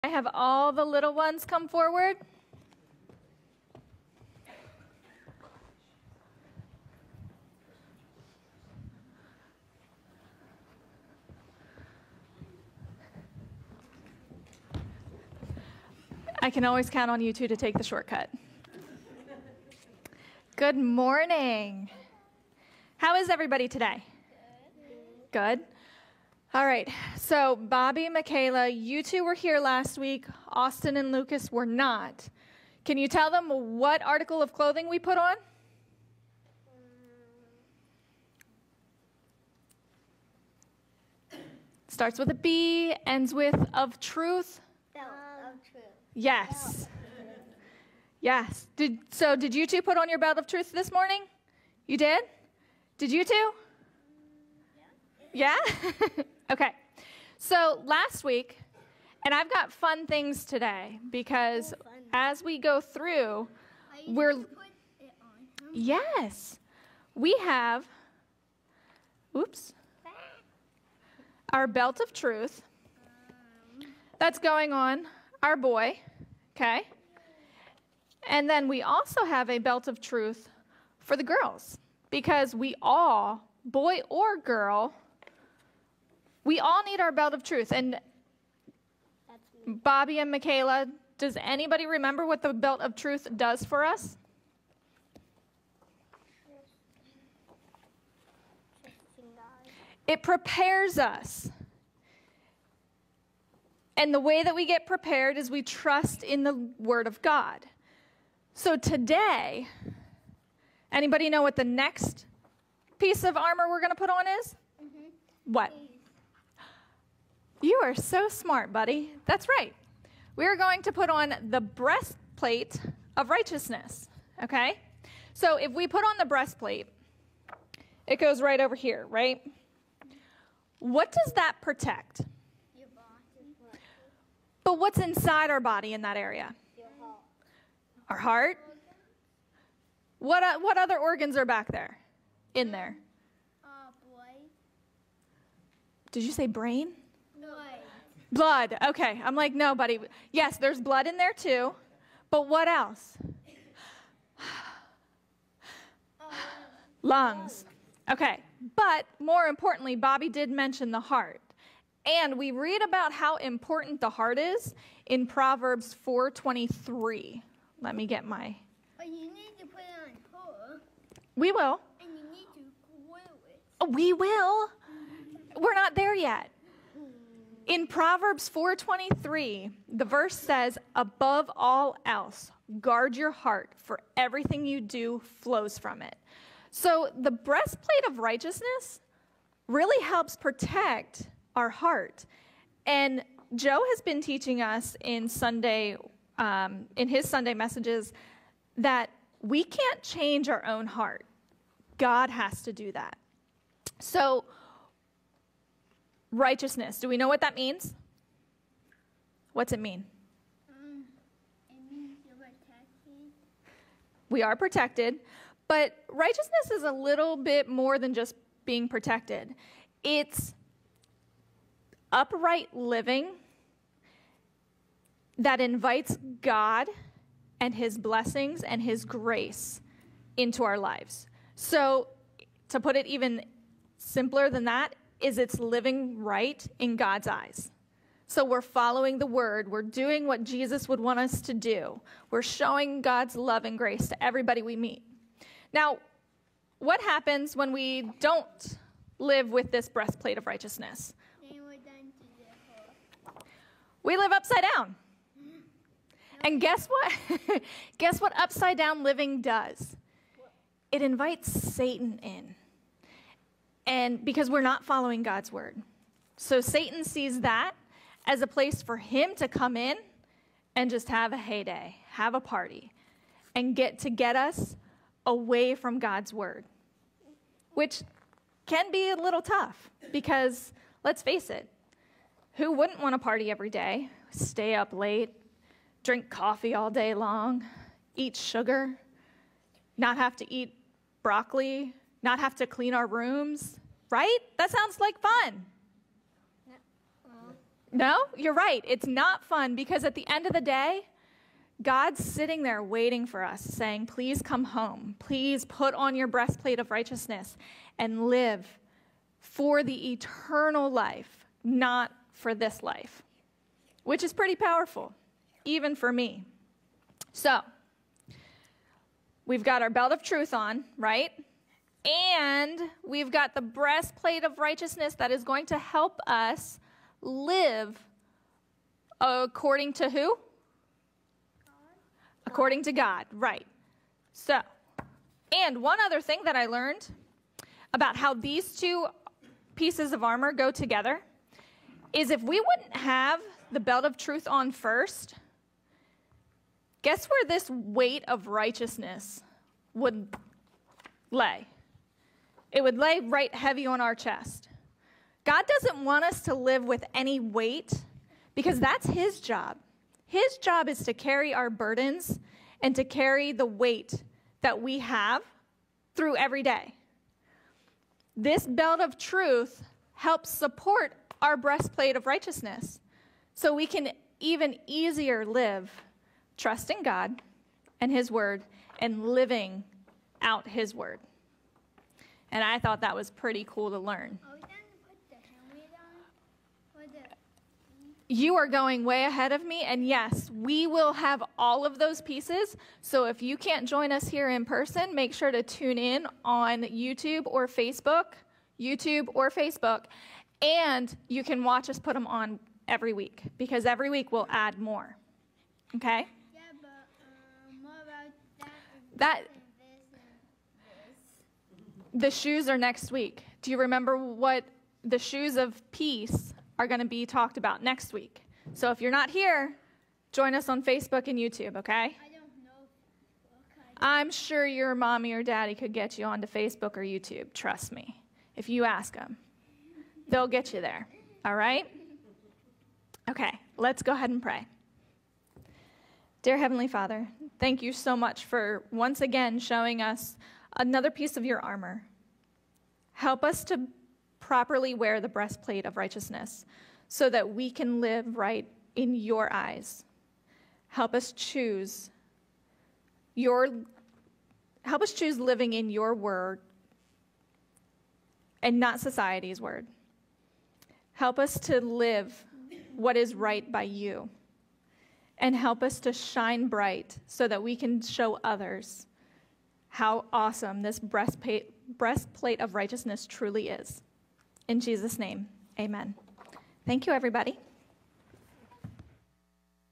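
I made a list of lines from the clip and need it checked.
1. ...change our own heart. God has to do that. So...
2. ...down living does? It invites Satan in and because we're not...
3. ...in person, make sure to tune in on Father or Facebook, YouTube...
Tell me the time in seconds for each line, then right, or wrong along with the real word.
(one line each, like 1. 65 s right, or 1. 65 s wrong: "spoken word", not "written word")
1. 200 s right
2. 258 s right
3. 394 s wrong: "YouTube", not "Father".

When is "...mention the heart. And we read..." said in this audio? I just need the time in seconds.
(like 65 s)
160 s.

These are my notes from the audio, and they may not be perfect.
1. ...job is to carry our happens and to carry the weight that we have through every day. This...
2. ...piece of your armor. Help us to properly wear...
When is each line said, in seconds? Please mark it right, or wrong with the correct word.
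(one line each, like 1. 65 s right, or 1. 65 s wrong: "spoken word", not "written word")
1. 360 s wrong: "burdens", not "happens"
2. 441 s right.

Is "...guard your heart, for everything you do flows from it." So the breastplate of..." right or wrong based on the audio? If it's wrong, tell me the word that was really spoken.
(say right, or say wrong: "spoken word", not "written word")
right.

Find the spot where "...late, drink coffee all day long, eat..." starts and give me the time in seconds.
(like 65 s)
284 s.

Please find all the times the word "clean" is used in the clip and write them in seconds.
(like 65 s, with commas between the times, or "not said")
292 s.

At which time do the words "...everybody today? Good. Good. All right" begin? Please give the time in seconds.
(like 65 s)
23 s.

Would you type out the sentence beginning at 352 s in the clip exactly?
It would lay right heavy on our chest.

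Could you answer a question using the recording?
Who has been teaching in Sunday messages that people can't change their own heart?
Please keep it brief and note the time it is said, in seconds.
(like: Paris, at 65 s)
Joe, at 193 s.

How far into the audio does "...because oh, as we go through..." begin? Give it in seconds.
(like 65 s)
61 s.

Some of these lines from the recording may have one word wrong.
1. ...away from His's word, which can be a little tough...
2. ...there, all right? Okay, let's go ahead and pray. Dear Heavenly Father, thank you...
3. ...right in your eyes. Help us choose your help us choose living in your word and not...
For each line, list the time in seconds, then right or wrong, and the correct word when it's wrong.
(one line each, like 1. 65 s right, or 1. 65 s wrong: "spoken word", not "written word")
1. 275 s wrong: "God", not "His"
2. 430 s right
3. 448 s right.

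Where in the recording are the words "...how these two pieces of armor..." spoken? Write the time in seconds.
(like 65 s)
338 s.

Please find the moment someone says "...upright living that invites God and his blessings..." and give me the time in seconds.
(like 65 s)
222 s.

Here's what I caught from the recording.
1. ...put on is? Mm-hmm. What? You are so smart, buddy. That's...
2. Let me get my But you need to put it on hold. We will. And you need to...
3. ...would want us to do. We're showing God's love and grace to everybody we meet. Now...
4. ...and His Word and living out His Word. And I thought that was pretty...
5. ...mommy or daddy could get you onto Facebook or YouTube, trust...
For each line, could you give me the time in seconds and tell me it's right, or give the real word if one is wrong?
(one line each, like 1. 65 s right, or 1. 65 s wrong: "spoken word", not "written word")
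1. 113 s right
2. 167 s right
3. 240 s right
4. 377 s right
5. 424 s right.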